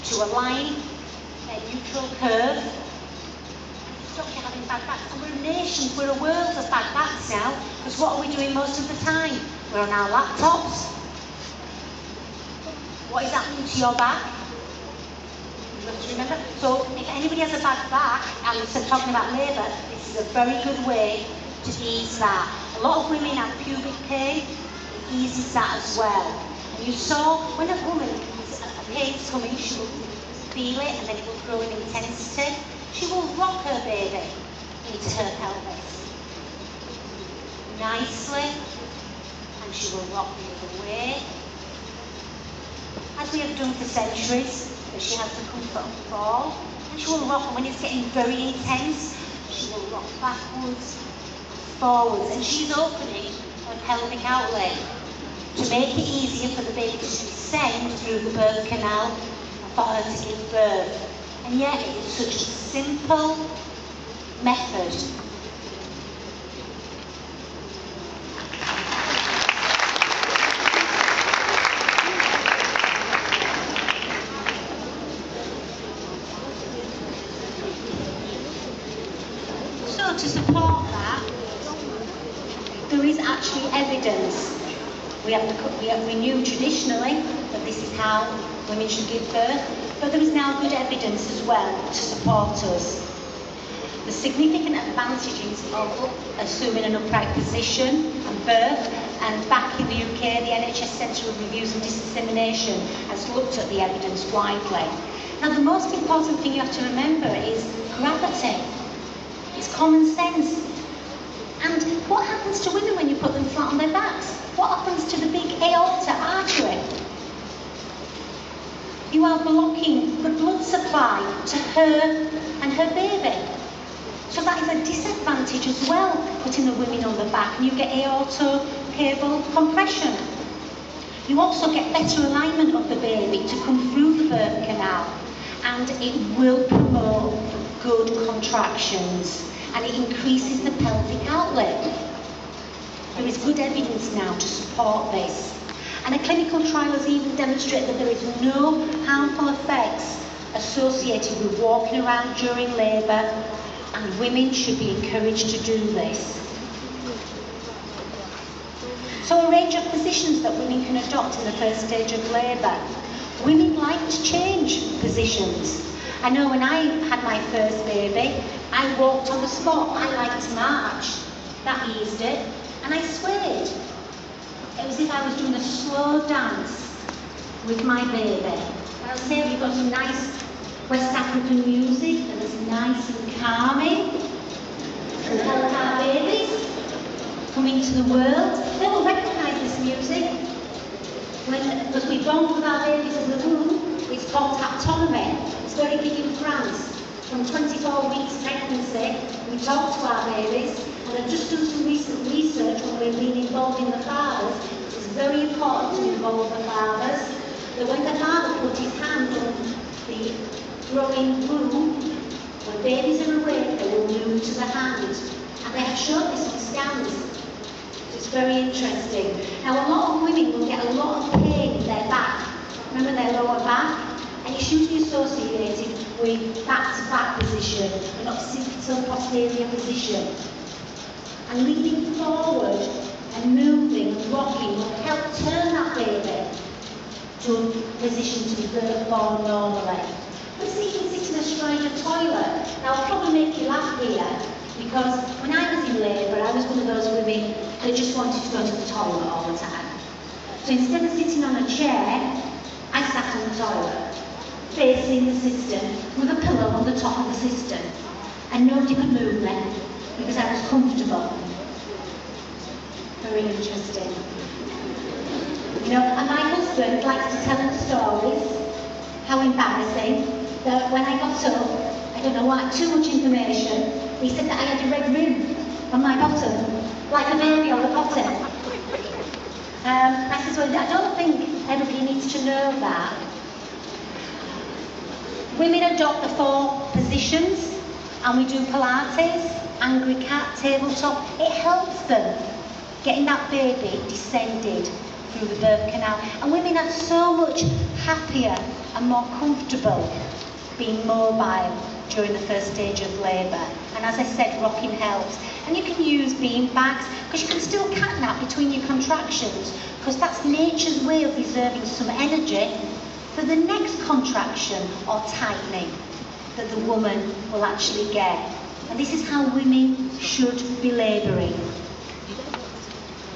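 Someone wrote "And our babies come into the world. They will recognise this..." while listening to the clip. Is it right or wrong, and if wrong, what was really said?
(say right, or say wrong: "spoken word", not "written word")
right.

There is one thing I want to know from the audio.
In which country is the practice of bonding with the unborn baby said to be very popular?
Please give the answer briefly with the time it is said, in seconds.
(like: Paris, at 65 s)
France, at 196 s.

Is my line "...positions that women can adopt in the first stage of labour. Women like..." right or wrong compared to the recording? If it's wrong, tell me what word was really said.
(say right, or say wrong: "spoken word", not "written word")
right.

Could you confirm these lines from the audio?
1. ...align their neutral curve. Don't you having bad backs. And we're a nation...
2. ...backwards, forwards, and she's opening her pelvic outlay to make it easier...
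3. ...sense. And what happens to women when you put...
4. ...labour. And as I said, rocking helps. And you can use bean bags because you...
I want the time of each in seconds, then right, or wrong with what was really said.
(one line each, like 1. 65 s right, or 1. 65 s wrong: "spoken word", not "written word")
1. 0 s right
2. 50 s right
3. 110 s right
4. 303 s right.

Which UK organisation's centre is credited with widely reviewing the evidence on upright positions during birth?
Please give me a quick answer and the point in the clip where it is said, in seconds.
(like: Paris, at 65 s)
NHS Centre of Reviews and Dissemination, at 100 s.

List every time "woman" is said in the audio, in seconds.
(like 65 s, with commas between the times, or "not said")
27 s, 316 s.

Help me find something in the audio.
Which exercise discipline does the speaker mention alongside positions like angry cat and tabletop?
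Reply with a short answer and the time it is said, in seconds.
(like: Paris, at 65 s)
Pilates, at 288 s.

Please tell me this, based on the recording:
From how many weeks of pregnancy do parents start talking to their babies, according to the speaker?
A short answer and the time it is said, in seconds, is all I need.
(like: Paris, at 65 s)
24 weeks, at 197 s.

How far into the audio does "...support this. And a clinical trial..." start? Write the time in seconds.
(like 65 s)
144 s.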